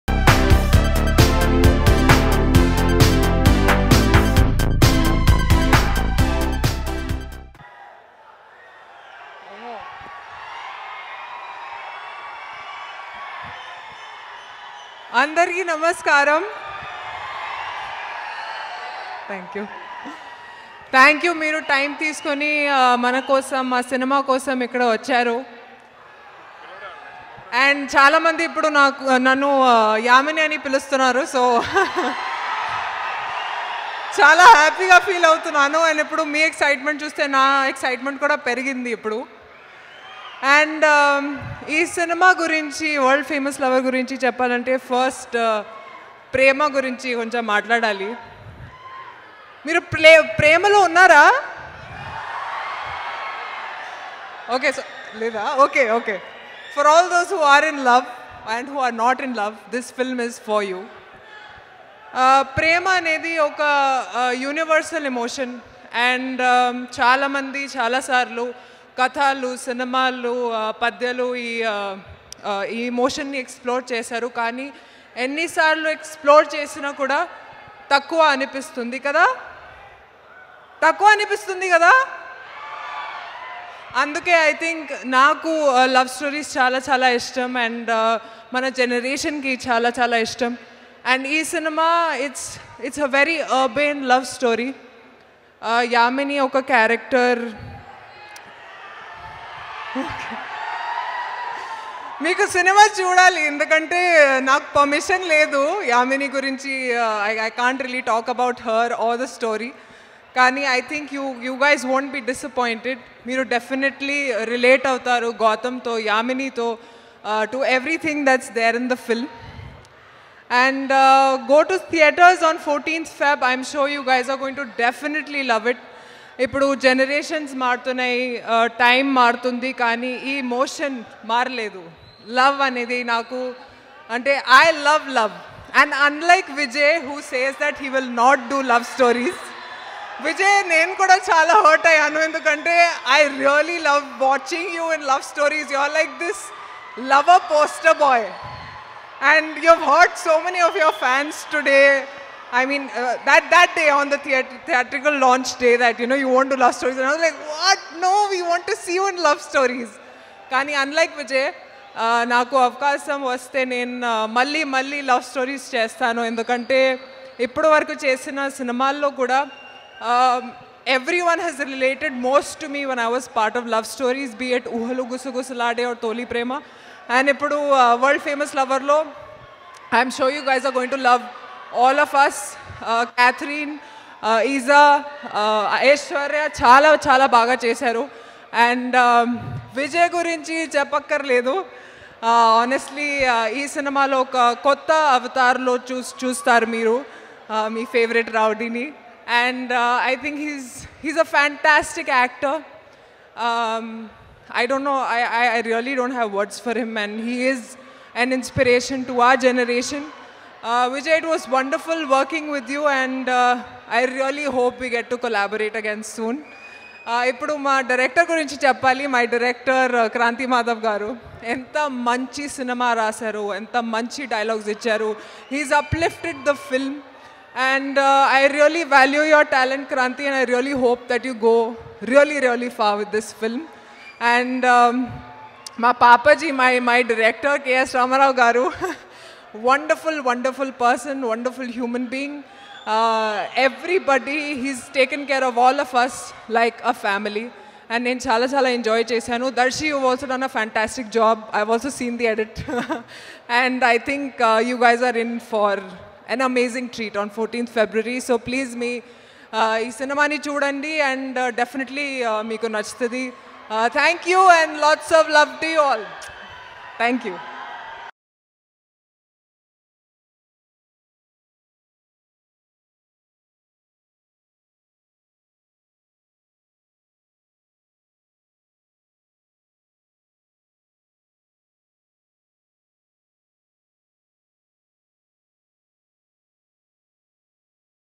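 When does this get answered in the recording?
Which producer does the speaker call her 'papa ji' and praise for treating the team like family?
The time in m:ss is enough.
3:57.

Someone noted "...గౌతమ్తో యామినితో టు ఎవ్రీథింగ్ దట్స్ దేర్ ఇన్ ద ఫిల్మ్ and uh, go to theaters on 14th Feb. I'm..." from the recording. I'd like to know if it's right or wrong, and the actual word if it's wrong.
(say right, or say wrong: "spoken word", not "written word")
right.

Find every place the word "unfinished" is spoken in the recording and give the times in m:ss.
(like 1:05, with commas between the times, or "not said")
not said.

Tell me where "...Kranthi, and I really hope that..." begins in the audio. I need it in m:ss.
3:49.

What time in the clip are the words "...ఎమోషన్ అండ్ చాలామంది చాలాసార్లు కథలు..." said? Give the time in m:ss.
1:05.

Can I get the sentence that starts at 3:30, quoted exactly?
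Uh, Vijay, it was wonderful working with you and uh, I really hope we get to collaborate again soon.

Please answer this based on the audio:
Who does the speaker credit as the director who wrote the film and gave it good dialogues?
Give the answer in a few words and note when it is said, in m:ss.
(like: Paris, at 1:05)
Kranthi Madhav, at 3:40.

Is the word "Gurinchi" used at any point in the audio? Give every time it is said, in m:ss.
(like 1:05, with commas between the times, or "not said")
3:10.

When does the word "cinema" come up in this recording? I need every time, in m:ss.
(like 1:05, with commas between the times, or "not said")
3:13, 3:42, 4:19.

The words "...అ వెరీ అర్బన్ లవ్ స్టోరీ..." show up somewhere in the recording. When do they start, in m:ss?
1:33.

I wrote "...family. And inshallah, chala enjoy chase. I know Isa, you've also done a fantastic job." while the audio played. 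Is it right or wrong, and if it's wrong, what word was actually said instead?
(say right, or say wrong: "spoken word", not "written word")
wrong: "Darshi", not "Isa".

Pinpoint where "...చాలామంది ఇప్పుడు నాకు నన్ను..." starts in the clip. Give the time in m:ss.
0:27.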